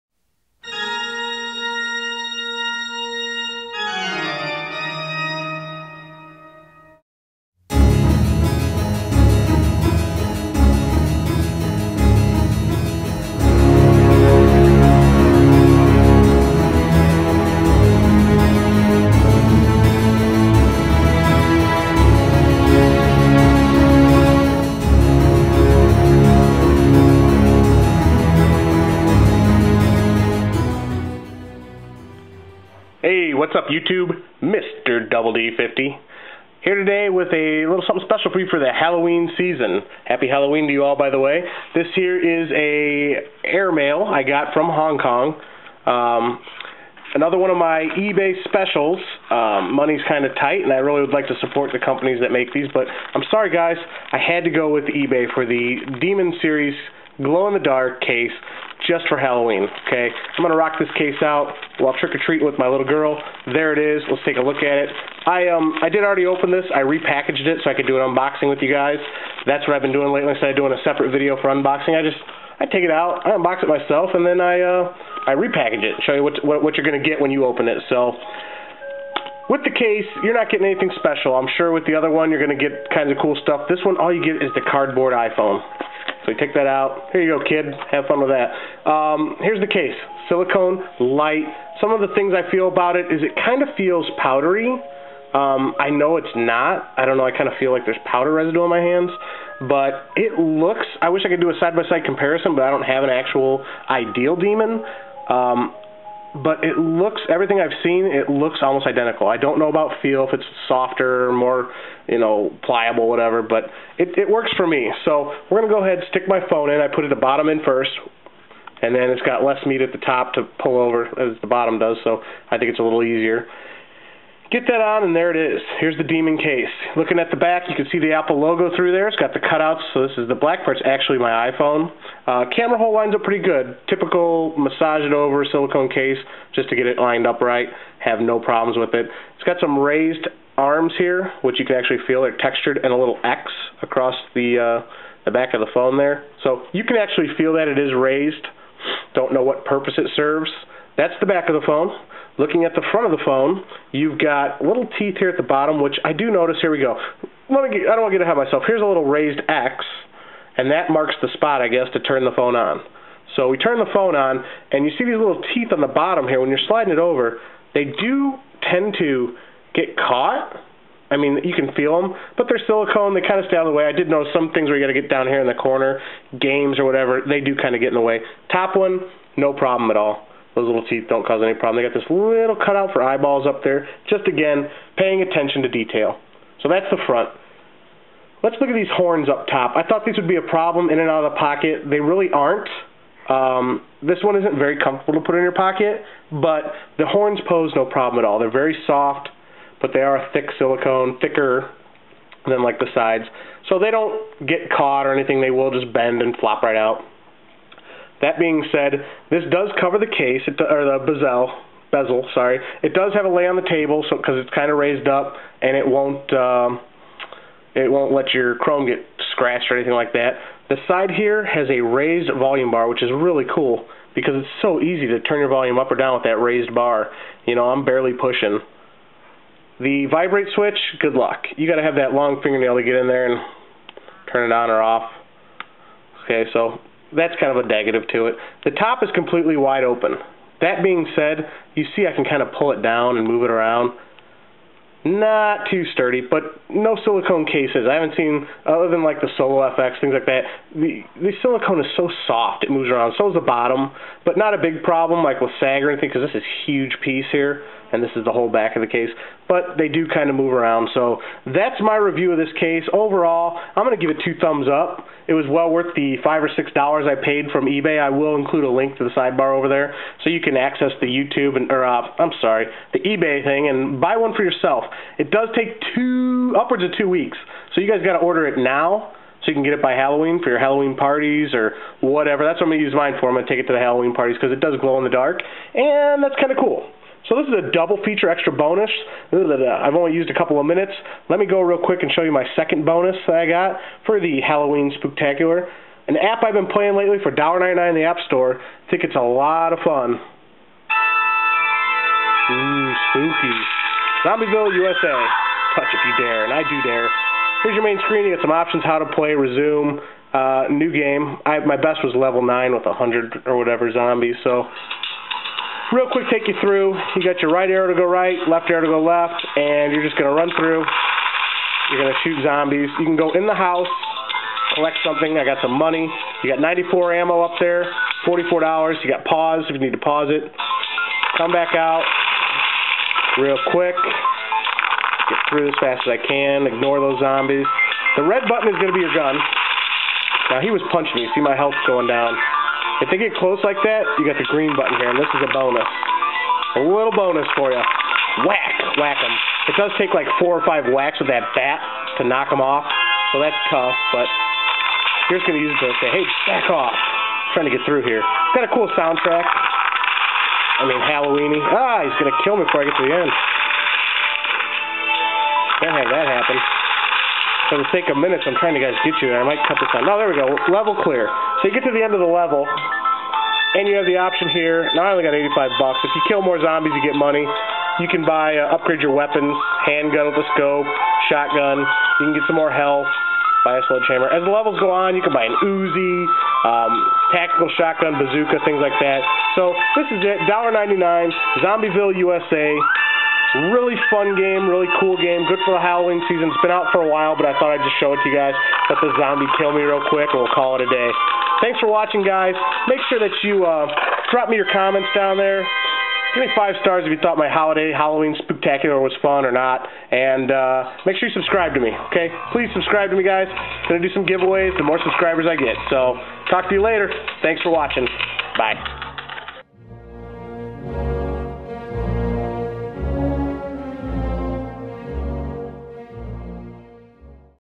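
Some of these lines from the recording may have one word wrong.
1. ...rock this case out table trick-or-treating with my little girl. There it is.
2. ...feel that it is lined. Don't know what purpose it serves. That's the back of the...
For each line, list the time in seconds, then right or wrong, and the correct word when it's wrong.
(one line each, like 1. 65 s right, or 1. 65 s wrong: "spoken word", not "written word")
1. 60 s wrong: "while", not "table"
2. 147 s wrong: "raised", not "lined".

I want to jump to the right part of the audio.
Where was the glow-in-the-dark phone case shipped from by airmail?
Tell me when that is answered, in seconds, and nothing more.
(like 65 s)
44 s.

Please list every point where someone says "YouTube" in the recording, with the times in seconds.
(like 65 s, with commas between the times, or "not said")
33 s, 271 s.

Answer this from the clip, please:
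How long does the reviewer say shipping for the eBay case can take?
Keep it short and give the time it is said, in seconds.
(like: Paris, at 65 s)
2 weeks, at 276 s.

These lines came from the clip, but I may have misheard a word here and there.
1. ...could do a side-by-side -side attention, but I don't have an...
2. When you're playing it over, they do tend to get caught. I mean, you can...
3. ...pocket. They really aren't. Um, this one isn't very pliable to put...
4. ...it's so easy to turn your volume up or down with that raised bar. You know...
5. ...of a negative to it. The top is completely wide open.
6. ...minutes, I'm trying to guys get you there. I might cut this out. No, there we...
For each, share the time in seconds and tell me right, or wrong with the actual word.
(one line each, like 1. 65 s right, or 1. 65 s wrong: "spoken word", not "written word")
1. 101 s wrong: "comparison", not "attention"
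2. 166 s wrong: "sliding", not "playing"
3. 191 s wrong: "comfortable", not "pliable"
4. 224 s right
5. 237 s right
6. 368 s right.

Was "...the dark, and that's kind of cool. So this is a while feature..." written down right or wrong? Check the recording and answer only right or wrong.
wrong.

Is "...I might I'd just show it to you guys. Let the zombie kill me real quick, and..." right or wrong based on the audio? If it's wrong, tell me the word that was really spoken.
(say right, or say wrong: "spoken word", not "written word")
wrong: "thought", not "might".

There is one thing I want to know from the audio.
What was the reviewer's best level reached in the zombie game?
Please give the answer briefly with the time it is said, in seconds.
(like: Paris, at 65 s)
level 9, at 312 s.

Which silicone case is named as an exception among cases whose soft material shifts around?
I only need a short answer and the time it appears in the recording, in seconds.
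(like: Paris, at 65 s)
Solo FX, at 249 s.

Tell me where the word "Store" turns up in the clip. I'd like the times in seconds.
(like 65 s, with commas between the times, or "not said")
298 s.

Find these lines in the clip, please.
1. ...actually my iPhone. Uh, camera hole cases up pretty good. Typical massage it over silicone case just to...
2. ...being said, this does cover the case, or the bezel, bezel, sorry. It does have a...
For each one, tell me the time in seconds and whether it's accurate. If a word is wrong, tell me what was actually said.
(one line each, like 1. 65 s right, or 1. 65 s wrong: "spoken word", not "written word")
1. 130 s wrong: "lines", not "cases"
2. 208 s right.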